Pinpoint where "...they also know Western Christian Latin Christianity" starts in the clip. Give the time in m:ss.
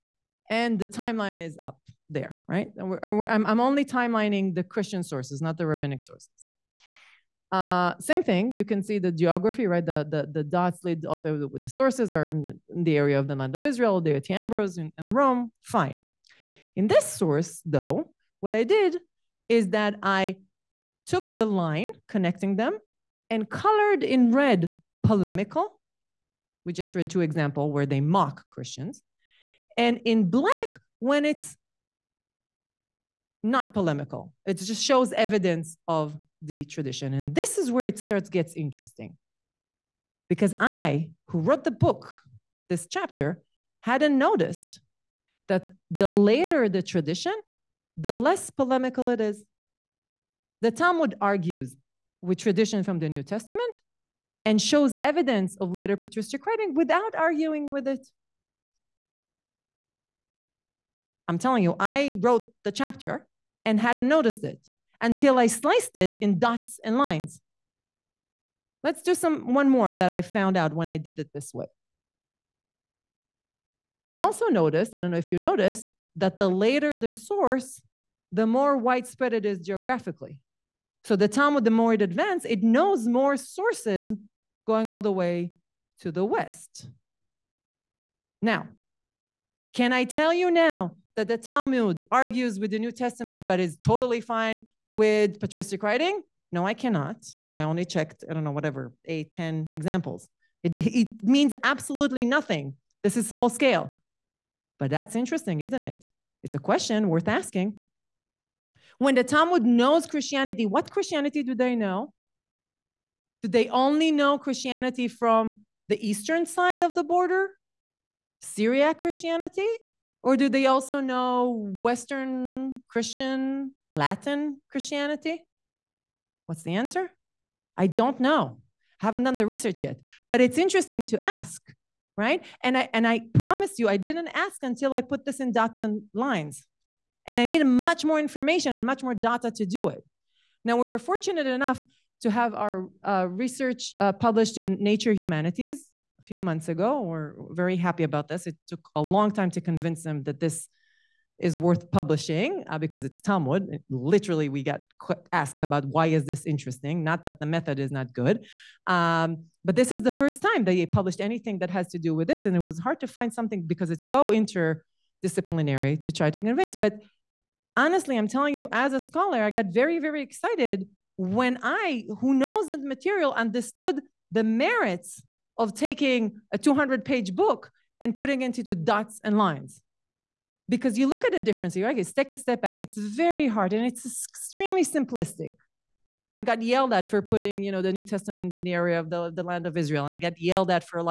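2:00.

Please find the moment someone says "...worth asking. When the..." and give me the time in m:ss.
1:47.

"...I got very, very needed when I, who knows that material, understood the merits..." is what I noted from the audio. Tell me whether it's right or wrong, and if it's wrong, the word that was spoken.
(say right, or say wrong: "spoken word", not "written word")
wrong: "excited", not "needed".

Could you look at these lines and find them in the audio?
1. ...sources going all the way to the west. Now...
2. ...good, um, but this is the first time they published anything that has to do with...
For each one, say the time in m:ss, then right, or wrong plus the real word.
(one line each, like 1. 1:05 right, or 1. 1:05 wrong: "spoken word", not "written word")
1. 1:23 right
2. 2:38 right.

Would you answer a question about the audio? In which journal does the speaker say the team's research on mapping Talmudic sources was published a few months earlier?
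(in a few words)
Nature Humanities.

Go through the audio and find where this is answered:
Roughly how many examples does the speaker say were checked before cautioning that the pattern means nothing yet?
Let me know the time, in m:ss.
1:39.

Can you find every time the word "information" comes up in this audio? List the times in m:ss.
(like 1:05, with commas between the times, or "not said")
2:18.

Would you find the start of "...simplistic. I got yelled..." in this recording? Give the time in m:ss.
3:04.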